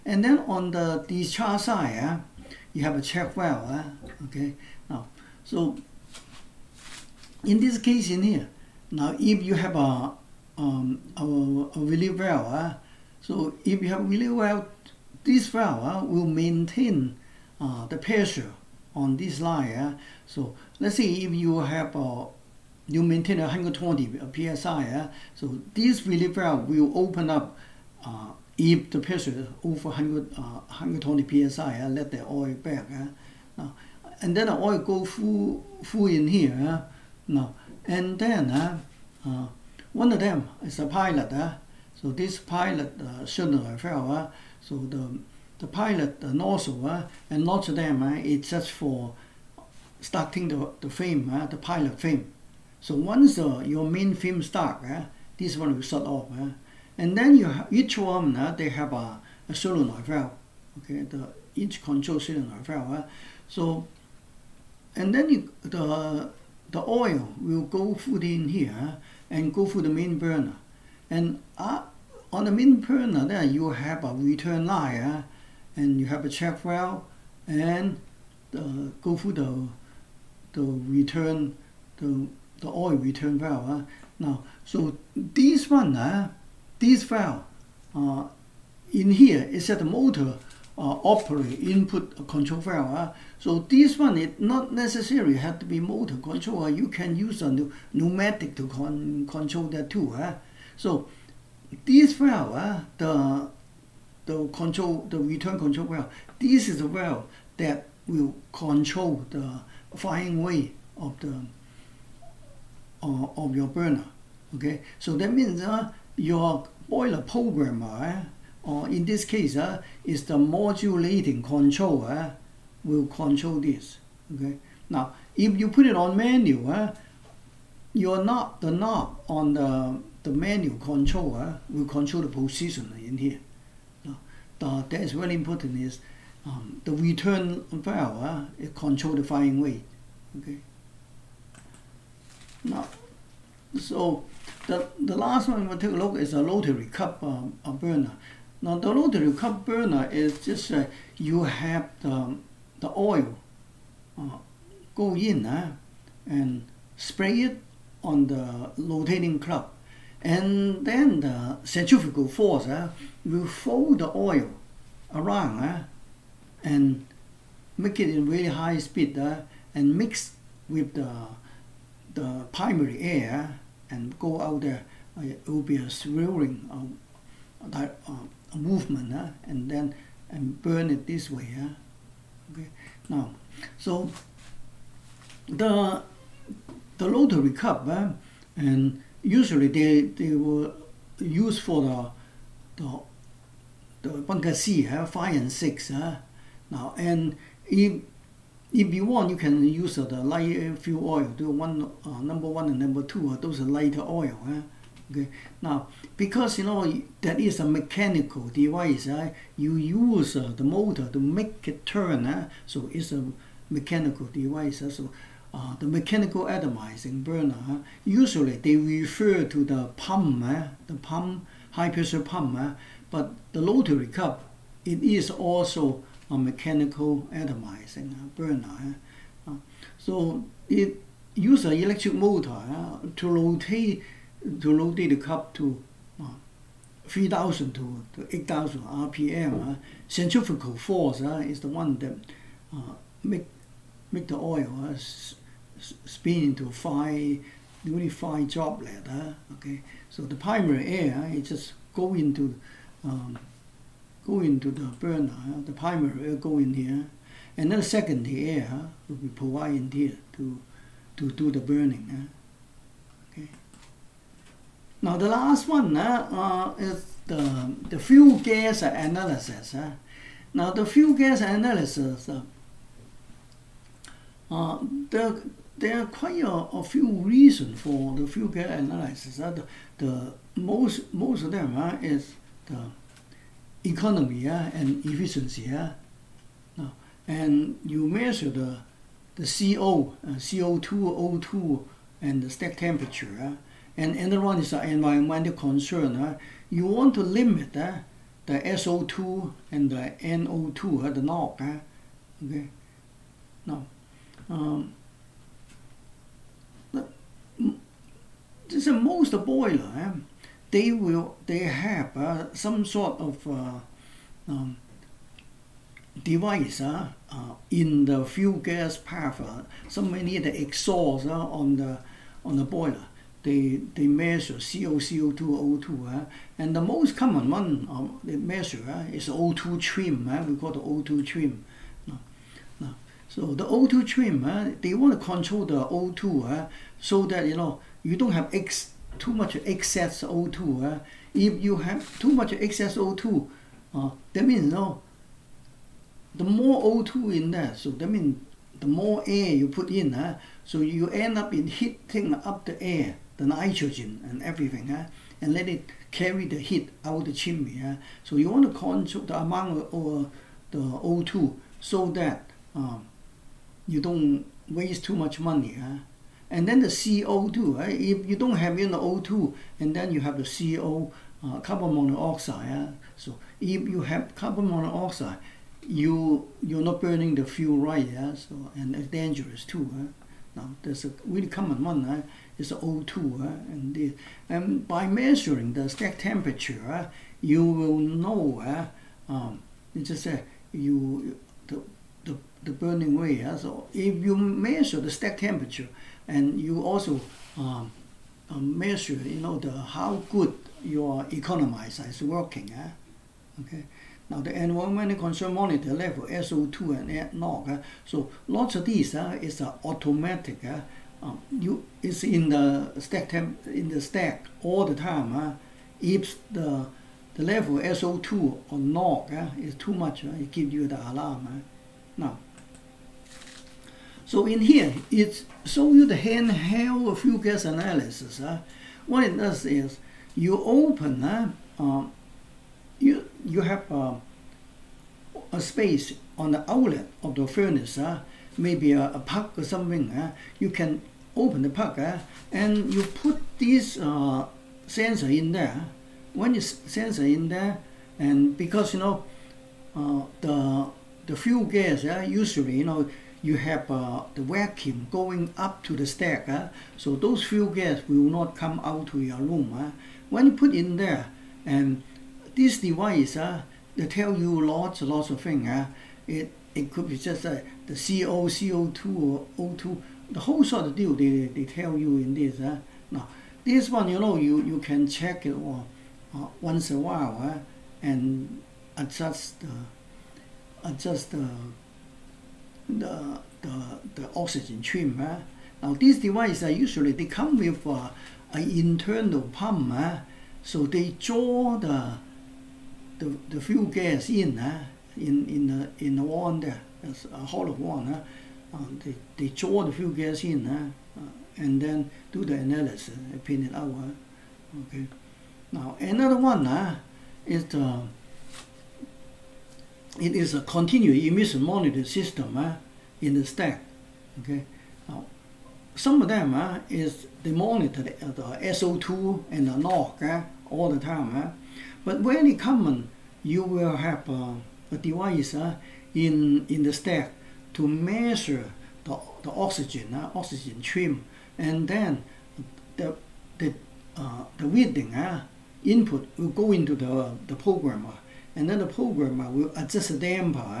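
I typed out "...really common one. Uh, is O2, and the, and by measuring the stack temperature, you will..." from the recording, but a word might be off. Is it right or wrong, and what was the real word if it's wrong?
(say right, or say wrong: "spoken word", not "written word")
right.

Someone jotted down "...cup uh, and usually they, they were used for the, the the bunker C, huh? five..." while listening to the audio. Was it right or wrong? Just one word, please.
right.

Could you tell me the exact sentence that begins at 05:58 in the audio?
So you want to control the amount of uh, the O2 so that um, you don't waste too much money.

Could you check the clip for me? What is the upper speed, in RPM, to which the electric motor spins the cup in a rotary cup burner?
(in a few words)
8,000 RPM.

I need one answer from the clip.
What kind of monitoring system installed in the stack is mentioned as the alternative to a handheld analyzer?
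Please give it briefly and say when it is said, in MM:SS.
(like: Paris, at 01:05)
continuous emission monitoring system, at 08:30.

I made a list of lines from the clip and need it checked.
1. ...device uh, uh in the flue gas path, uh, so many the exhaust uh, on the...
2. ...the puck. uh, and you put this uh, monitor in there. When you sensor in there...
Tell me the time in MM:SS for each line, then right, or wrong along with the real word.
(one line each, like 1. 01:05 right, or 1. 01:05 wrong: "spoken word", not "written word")
1. 05:16 right
2. 07:21 wrong: "sensor", not "monitor".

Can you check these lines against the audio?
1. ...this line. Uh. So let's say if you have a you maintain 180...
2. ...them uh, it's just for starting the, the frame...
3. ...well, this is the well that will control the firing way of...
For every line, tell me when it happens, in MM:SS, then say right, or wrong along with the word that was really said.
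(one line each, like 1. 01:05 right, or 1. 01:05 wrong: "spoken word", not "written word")
1. 00:19 wrong: "120", not "180"
2. 00:47 right
3. 01:45 right.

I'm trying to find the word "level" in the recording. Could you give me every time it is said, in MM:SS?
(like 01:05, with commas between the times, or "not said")
06:45, 06:57.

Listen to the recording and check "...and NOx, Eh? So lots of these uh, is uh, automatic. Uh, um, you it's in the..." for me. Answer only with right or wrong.
right.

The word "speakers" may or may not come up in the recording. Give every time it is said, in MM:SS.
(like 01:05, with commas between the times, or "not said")
not said.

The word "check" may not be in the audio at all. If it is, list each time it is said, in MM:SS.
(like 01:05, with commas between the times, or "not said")
00:03, 01:16, 07:55.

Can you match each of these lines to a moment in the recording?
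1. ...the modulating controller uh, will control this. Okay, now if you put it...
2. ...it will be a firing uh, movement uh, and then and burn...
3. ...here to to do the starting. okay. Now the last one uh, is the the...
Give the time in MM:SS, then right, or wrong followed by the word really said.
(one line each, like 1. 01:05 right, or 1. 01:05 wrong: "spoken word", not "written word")
1. 02:00 right
2. 02:55 wrong: "swirling", not "firing"
3. 04:19 wrong: "burning", not "starting".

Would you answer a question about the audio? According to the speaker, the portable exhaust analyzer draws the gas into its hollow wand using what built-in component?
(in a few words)
internal pump.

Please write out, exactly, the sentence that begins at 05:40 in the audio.
Uh, if you have too much excess O2, uh, that means no.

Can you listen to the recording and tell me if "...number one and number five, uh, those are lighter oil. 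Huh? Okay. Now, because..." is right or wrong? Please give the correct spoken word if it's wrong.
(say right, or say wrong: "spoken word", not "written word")
wrong: "two", not "five".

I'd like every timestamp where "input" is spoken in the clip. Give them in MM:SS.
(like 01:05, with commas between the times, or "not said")
01:31, 08:55.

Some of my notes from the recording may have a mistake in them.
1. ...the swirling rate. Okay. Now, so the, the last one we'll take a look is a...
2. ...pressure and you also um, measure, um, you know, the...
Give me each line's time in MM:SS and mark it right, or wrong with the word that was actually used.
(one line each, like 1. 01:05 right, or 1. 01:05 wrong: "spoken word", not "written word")
1. 02:19 wrong: "firing", not "swirling"
2. 06:35 wrong: "temperature", not "pressure".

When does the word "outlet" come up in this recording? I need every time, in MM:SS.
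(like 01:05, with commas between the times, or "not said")
07:16.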